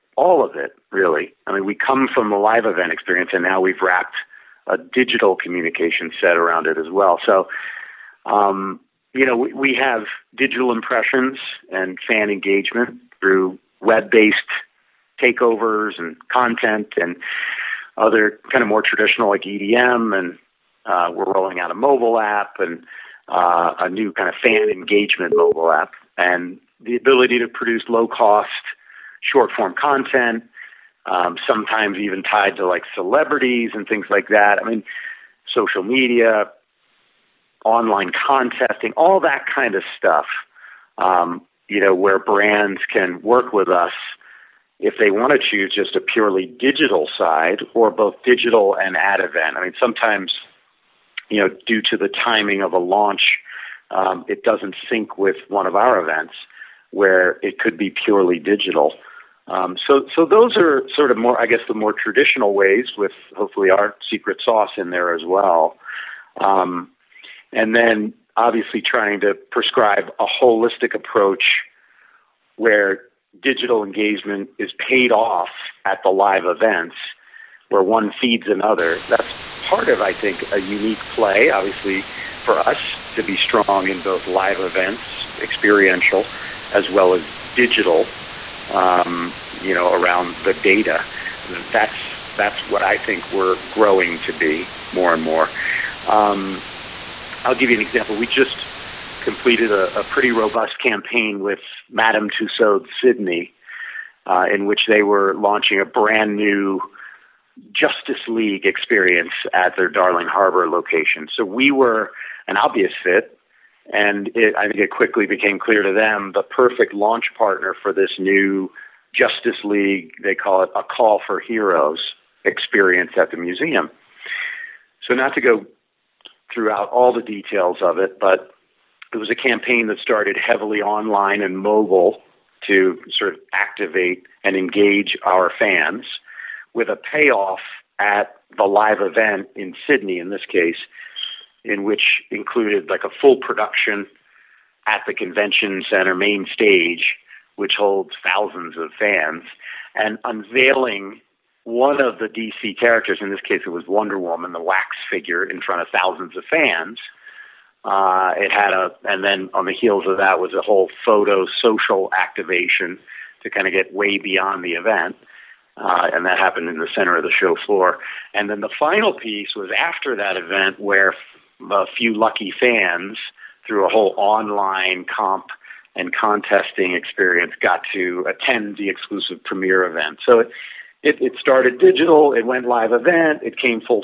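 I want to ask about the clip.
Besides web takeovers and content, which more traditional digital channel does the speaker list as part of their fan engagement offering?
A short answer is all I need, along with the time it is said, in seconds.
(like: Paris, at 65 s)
EDM, at 19 s.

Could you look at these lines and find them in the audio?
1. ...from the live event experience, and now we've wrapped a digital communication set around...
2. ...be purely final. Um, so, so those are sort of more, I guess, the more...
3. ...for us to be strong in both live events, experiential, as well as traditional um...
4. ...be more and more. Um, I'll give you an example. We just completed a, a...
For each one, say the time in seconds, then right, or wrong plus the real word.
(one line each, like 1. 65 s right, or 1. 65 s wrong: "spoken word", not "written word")
1. 2 s right
2. 57 s wrong: "digital", not "final"
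3. 82 s wrong: "digital", not "traditional"
4. 94 s right.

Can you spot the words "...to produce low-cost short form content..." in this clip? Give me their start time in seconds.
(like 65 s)
27 s.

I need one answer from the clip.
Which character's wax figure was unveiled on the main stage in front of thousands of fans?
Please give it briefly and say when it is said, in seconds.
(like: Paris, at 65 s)
Wonder Woman, at 153 s.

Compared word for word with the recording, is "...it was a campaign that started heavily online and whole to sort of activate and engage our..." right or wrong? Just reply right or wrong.
wrong.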